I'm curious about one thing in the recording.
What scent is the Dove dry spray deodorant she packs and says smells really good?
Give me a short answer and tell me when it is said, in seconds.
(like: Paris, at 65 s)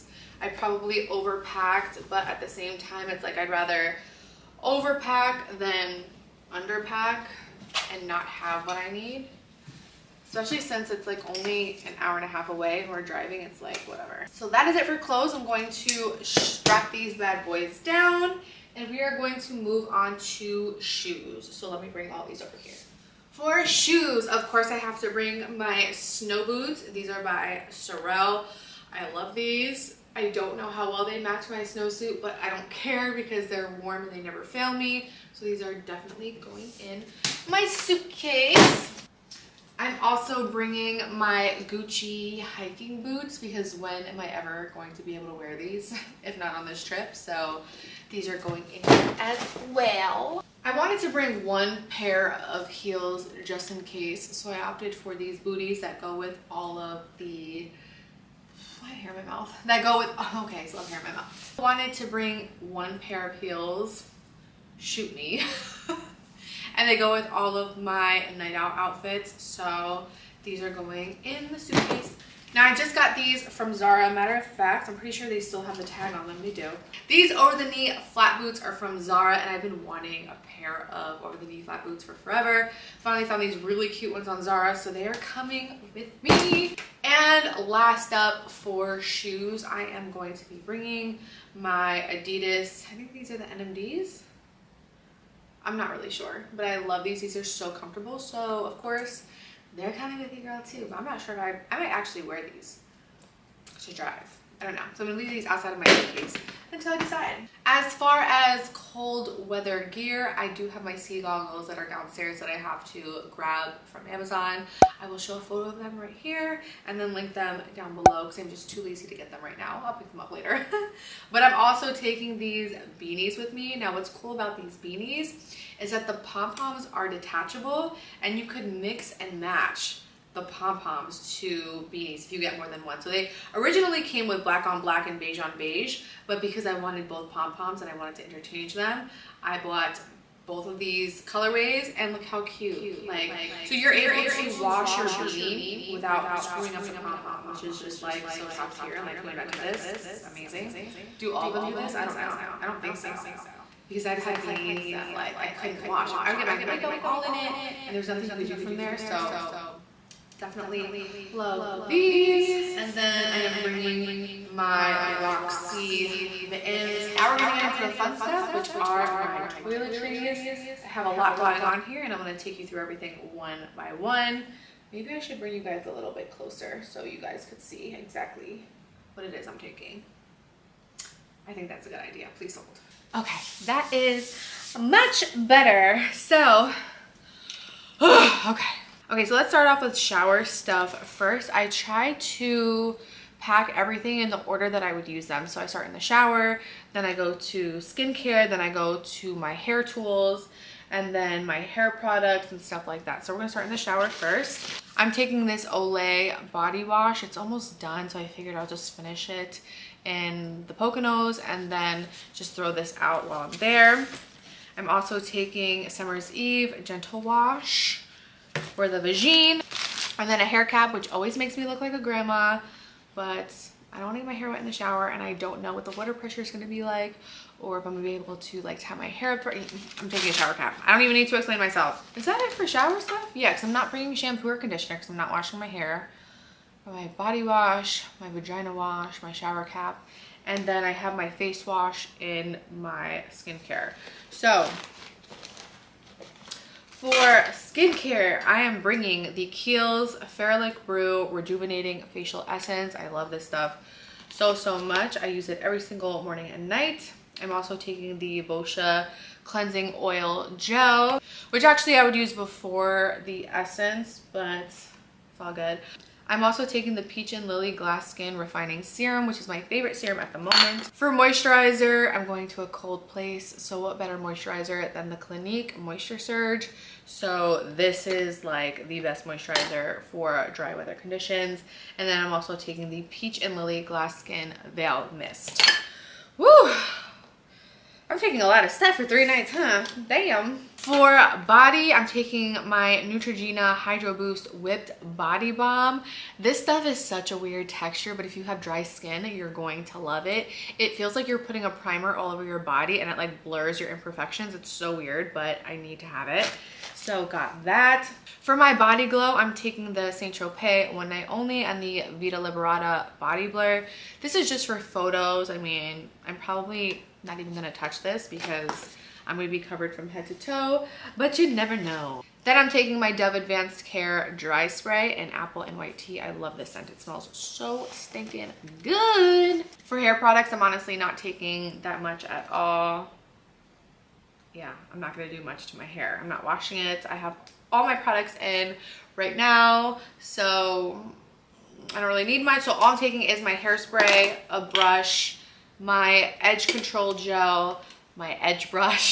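Apple and White Tea, at 325 s.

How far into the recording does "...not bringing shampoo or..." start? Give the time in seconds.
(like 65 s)
233 s.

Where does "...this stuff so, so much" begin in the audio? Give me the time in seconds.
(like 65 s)
253 s.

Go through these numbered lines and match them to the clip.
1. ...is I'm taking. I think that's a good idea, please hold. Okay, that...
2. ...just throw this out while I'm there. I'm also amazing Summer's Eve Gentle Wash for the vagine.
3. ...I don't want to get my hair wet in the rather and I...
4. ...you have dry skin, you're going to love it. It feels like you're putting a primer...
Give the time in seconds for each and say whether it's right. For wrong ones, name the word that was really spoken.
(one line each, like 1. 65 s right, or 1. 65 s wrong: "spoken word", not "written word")
1. 179 s right
2. 212 s wrong: "taking", not "amazing"
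3. 223 s wrong: "shower", not "rather"
4. 298 s right.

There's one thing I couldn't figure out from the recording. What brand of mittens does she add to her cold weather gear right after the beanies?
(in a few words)
Roxy.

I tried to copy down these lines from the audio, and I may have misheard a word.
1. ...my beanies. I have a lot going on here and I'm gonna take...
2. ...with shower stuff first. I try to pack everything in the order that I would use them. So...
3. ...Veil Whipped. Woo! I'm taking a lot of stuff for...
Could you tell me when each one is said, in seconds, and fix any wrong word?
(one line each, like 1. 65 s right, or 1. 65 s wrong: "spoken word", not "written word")
1. 169 s wrong: "toiletries", not "beanies"
2. 189 s right
3. 284 s wrong: "Mist", not "Whipped".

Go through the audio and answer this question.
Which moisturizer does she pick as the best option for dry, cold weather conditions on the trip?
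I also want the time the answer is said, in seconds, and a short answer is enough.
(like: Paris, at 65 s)
Clinique Moisture Surge, at 275 s.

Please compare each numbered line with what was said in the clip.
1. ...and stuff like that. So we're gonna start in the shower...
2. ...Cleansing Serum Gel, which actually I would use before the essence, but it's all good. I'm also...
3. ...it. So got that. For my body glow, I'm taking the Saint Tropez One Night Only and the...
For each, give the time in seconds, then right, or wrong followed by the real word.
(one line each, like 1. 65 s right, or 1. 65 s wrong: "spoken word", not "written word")
1. 202 s right
2. 259 s wrong: "Oil", not "Serum"
3. 306 s right.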